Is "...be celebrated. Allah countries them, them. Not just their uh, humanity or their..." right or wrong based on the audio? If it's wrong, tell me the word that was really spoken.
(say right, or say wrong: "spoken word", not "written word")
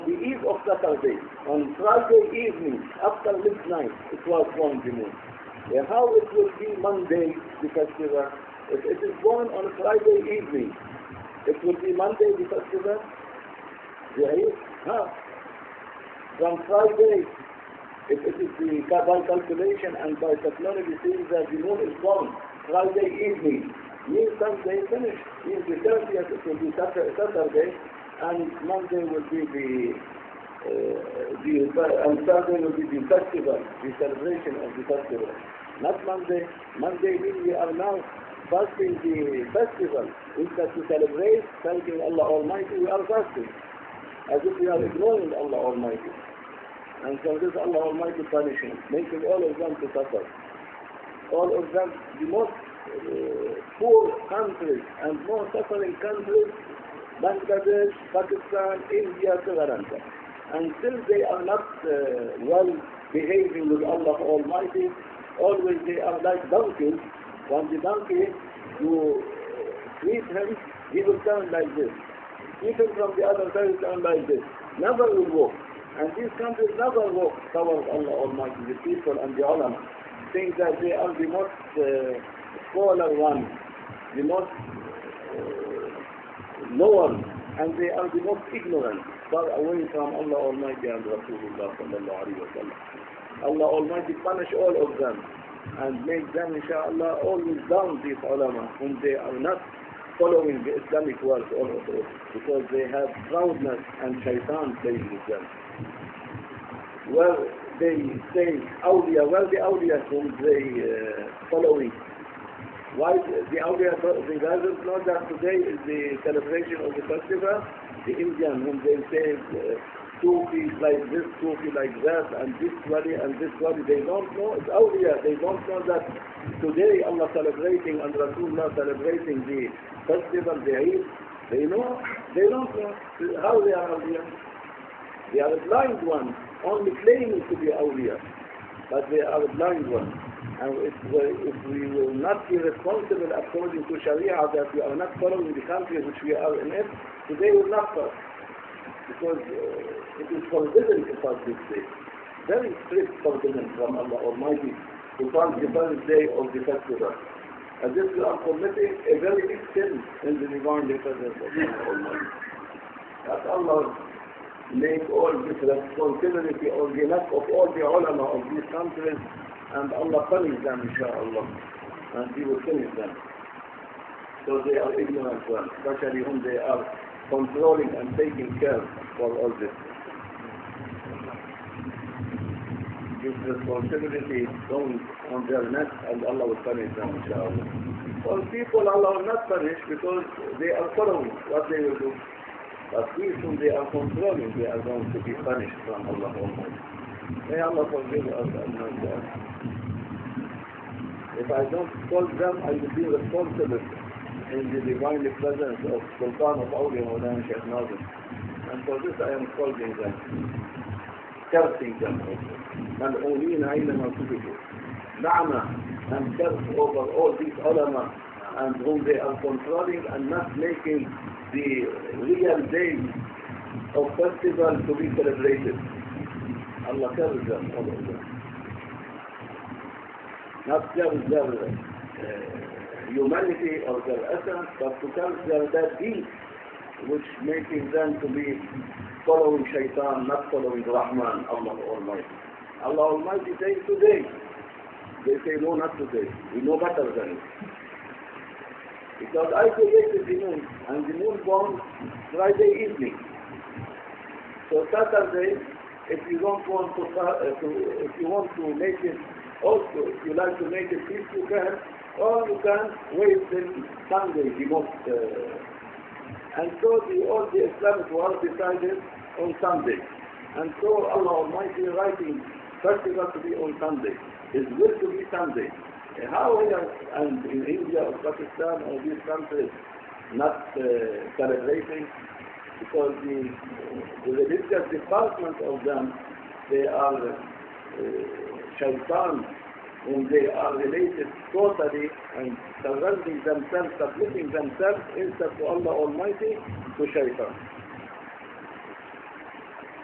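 wrong: "carries", not "countries".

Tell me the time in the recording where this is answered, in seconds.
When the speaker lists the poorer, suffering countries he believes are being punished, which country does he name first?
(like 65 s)
57 s.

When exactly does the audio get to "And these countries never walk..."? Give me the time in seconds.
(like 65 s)
75 s.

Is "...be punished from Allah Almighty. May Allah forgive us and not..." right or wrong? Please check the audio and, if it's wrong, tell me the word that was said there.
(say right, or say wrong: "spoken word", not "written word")
right.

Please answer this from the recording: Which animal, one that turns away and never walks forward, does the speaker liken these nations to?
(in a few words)
donkeys.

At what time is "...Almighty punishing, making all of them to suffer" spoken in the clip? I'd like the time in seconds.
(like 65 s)
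47 s.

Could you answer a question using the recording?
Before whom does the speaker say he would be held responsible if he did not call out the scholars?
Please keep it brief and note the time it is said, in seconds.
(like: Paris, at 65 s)
Maulana Sheikh Nazim, at 207 s.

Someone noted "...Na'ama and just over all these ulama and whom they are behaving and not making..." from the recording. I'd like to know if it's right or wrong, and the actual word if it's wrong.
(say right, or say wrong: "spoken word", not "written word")
wrong: "controlling", not "behaving".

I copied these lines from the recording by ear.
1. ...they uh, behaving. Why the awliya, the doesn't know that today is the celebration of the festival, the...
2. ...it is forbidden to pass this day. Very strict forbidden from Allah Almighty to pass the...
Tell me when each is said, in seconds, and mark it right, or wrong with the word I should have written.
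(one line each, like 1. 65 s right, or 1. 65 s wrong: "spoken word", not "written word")
1. 110 s wrong: "following", not "behaving"
2. 150 s right.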